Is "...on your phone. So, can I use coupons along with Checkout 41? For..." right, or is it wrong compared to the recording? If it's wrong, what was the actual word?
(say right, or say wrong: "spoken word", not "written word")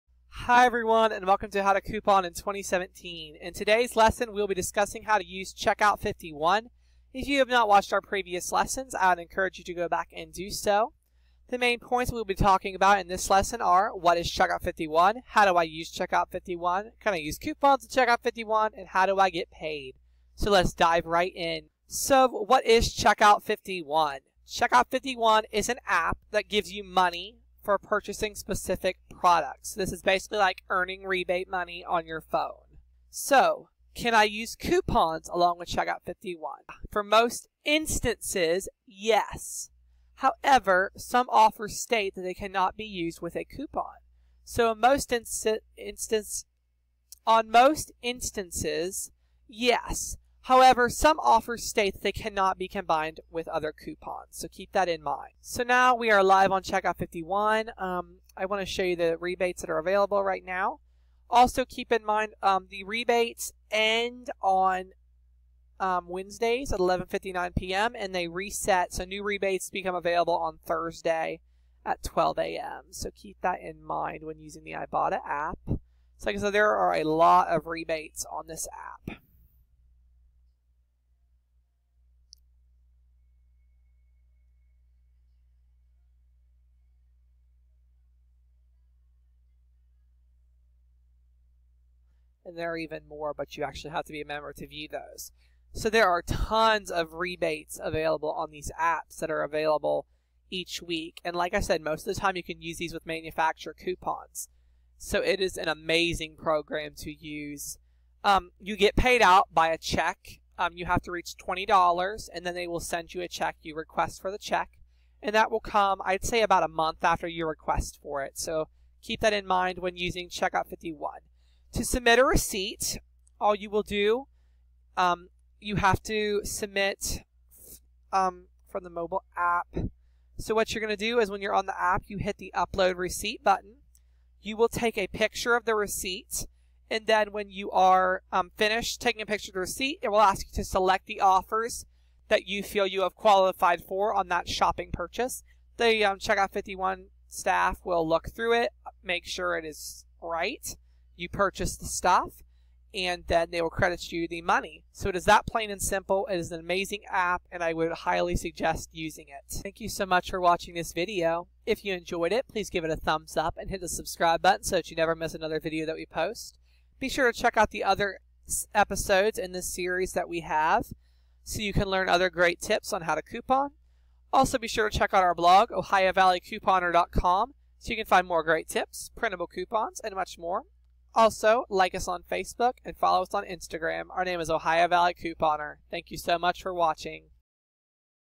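wrong: "51", not "41".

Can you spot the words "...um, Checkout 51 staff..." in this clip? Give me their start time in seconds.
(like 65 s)
146 s.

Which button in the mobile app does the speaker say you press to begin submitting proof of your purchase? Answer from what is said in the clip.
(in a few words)
Upload receipt.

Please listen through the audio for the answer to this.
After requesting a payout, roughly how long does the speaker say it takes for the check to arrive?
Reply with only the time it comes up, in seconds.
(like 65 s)
116 s.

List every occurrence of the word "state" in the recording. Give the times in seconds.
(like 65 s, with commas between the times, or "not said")
41 s, 51 s.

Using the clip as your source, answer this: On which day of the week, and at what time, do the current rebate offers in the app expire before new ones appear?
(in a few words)
Wednesdays at 11:59 p.m.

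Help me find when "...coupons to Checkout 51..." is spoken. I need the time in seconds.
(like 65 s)
17 s.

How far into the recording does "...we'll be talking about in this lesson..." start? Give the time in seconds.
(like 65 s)
12 s.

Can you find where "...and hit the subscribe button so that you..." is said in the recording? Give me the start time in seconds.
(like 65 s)
163 s.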